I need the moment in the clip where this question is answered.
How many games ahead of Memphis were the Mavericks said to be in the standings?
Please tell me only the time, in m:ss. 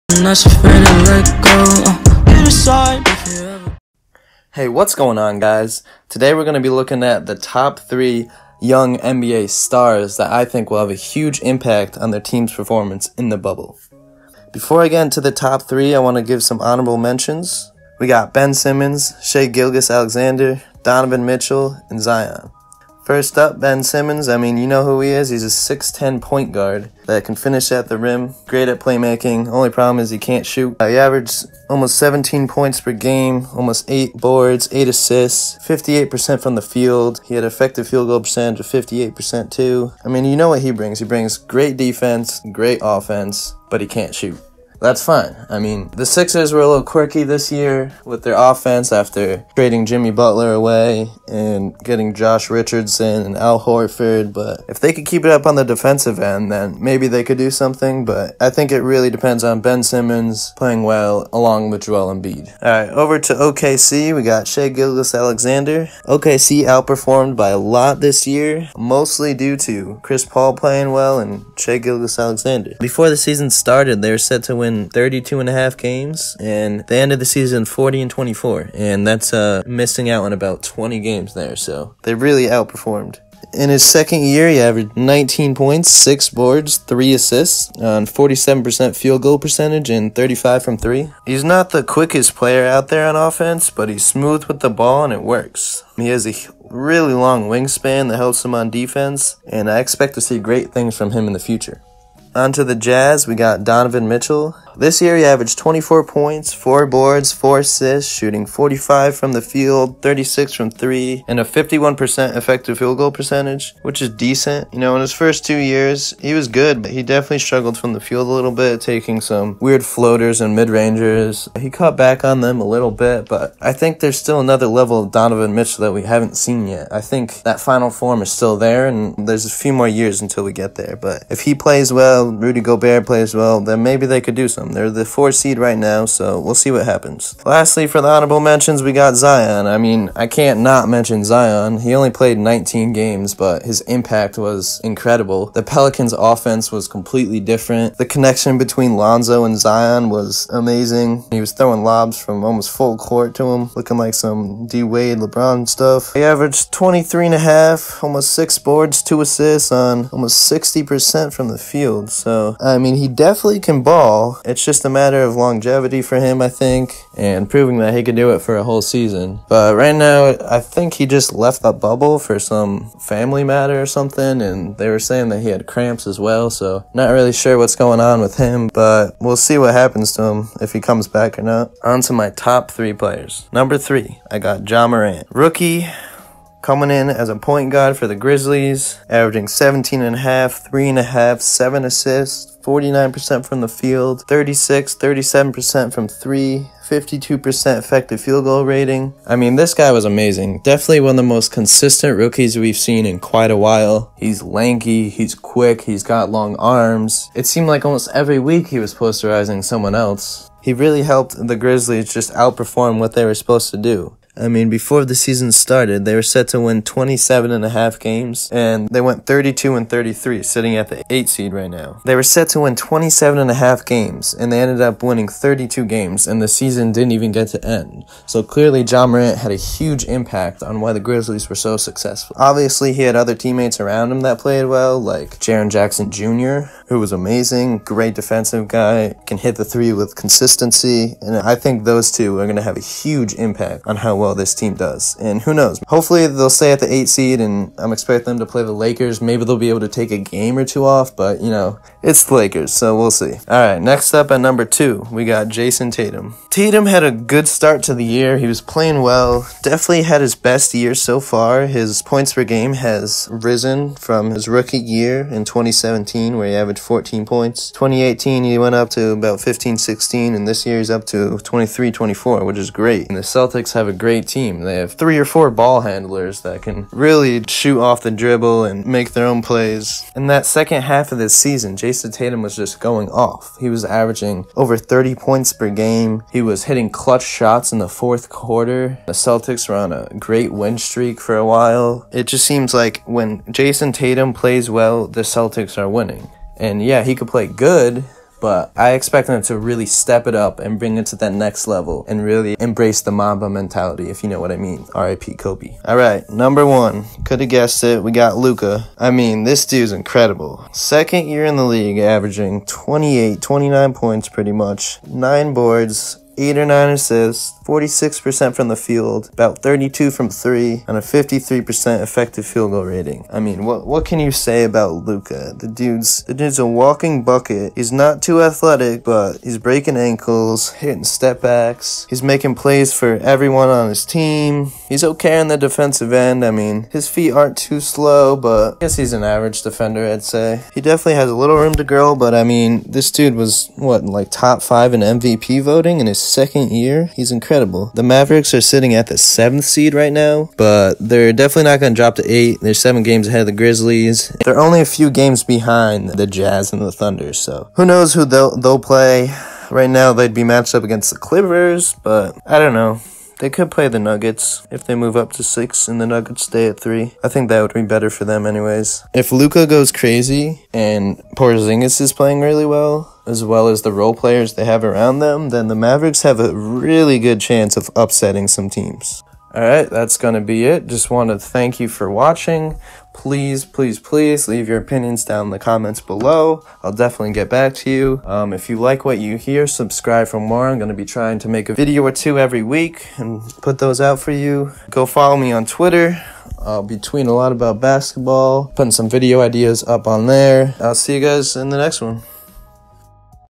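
5:52.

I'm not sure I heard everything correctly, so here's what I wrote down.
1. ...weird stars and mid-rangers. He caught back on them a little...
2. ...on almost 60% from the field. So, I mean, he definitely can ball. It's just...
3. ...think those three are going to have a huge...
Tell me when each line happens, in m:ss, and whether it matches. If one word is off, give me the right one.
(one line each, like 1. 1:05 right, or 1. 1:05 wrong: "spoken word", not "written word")
1. 1:59 wrong: "floaters", not "stars"
2. 2:39 right
3. 4:01 wrong: "two", not "three".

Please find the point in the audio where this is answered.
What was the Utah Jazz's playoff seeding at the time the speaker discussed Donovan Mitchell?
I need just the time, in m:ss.
2:15.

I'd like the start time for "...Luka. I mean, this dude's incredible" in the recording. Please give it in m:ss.
5:08.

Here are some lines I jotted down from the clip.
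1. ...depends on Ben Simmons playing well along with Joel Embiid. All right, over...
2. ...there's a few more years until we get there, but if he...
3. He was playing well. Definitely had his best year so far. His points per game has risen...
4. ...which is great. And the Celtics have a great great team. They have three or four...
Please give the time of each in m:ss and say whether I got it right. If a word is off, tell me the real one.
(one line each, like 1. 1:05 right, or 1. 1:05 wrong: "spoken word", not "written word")
1. 0:59 right
2. 2:09 right
3. 4:18 right
4. 4:32 right.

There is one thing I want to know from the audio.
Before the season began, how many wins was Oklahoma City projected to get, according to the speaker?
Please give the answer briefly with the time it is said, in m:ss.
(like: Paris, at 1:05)
32.5, at 1:14.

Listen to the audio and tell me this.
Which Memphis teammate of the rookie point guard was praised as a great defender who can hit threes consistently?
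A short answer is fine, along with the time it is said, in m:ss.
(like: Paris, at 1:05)
Jaren Jackson Jr., at 3:55.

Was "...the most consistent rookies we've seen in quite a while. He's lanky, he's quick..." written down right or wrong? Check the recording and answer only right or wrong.
right.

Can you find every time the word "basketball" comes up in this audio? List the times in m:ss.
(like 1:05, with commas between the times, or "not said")
6:37.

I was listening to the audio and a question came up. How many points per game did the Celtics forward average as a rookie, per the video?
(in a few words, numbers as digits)
14.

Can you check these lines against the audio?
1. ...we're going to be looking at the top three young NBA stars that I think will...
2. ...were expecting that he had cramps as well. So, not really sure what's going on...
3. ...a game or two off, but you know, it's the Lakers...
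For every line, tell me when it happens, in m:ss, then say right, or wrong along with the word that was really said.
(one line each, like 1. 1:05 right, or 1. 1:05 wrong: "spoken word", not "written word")
1. 0:06 right
2. 2:54 wrong: "saying", not "expecting"
3. 4:10 right.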